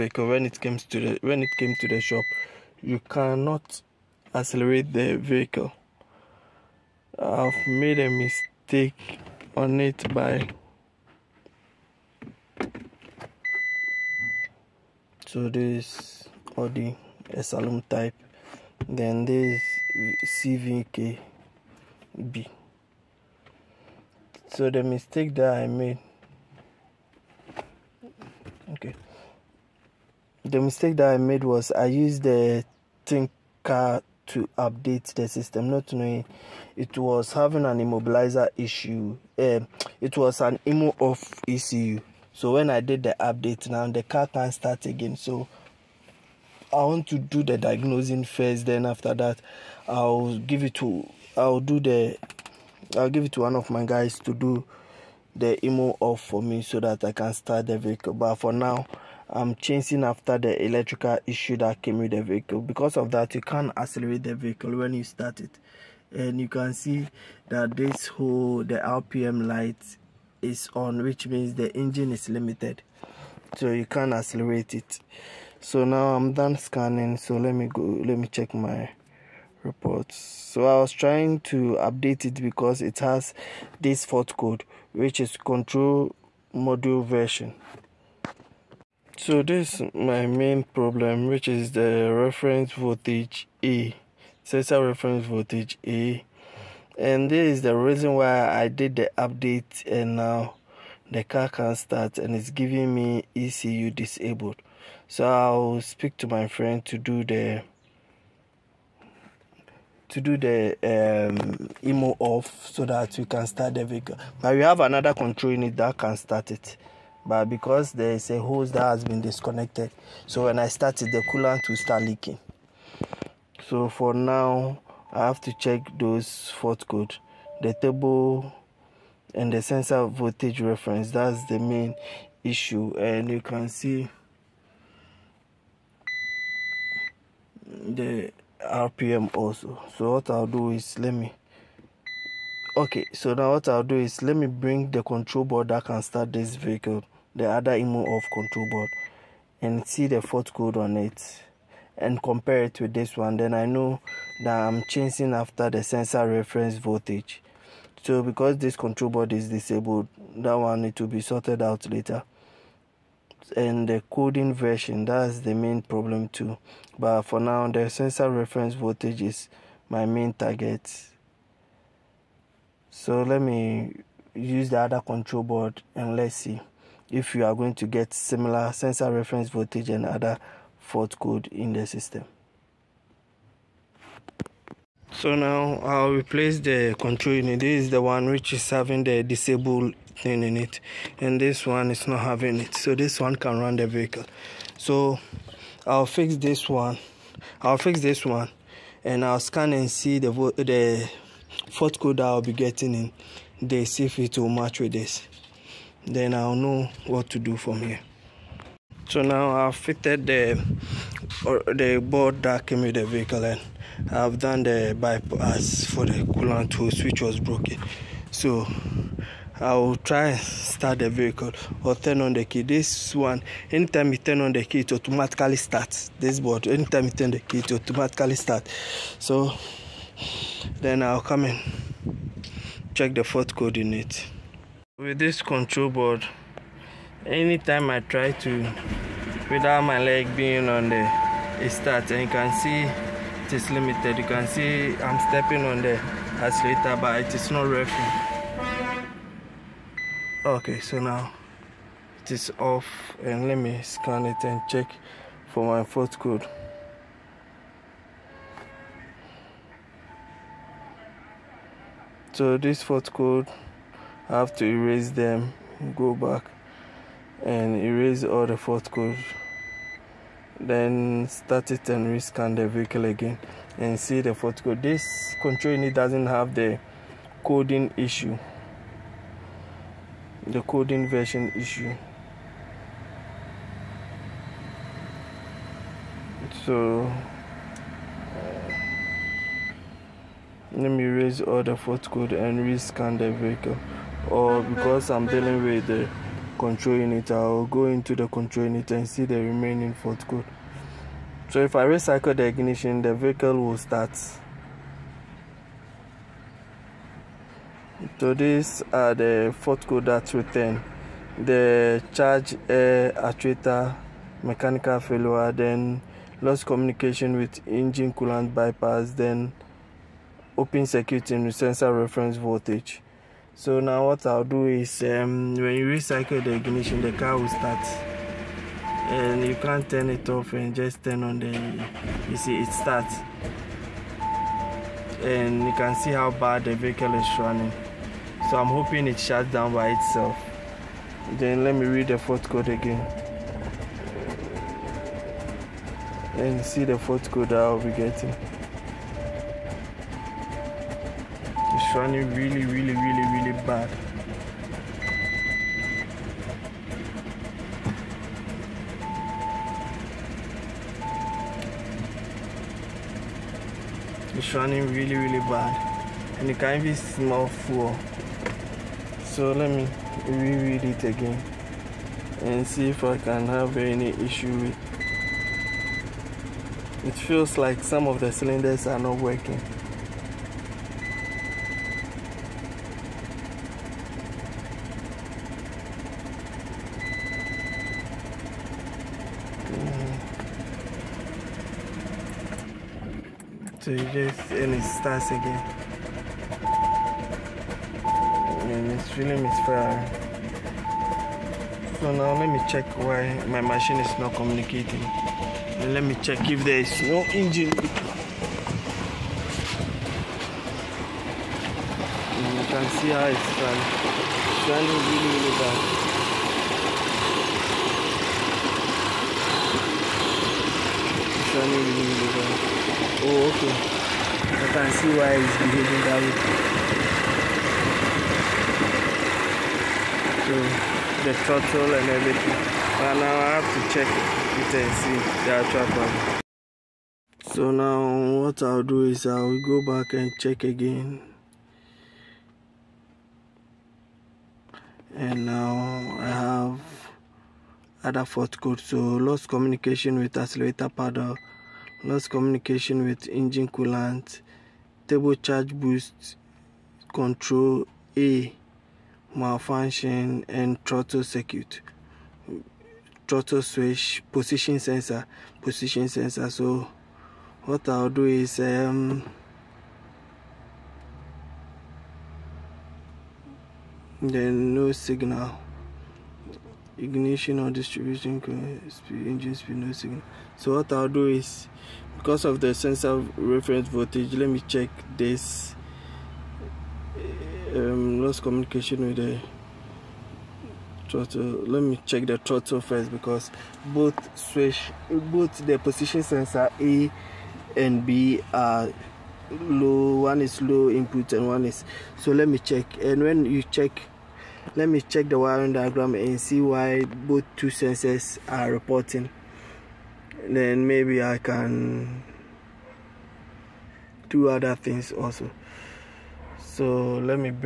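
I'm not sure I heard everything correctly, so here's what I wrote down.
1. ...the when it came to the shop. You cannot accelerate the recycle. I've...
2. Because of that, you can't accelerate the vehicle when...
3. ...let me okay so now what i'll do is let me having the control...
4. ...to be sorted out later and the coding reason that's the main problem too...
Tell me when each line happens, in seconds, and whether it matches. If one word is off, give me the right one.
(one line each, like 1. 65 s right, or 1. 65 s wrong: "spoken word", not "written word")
1. 0 s wrong: "vehicle", not "recycle"
2. 62 s right
3. 140 s wrong: "bring", not "having"
4. 160 s wrong: "version", not "reason".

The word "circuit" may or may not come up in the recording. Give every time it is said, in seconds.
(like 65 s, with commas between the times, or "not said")
320 s, 461 s.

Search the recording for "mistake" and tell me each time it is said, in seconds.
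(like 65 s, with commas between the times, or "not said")
8 s, 24 s, 30 s.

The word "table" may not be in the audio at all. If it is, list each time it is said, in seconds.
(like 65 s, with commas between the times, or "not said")
127 s, 455 s.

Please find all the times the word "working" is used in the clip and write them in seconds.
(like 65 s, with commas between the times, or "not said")
247 s, 379 s.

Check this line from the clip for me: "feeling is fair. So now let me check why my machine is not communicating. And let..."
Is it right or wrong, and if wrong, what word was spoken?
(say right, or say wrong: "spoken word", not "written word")
right.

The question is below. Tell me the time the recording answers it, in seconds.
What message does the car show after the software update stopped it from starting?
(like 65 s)
103 s.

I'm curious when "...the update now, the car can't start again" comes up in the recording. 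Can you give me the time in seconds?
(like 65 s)
43 s.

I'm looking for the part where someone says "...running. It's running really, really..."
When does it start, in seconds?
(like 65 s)
413 s.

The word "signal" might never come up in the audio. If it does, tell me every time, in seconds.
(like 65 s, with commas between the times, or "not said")
474 s, 479 s.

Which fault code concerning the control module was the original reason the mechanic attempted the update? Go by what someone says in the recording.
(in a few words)
Control module version.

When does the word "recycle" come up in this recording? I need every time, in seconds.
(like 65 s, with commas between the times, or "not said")
301 s, 325 s.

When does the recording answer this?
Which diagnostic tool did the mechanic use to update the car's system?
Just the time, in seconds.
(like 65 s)
33 s.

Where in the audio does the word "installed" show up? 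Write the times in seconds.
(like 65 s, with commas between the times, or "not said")
not said.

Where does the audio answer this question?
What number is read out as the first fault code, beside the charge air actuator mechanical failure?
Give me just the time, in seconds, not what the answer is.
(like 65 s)
310 s.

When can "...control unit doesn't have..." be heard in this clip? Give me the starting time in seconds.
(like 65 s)
275 s.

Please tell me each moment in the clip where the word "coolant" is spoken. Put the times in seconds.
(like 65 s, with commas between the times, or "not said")
121 s, 216 s, 318 s, 453 s.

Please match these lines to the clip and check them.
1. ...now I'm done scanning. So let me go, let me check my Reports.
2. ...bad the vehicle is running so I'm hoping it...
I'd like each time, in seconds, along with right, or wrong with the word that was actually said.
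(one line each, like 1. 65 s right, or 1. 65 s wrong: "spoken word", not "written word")
1. 75 s right
2. 336 s right.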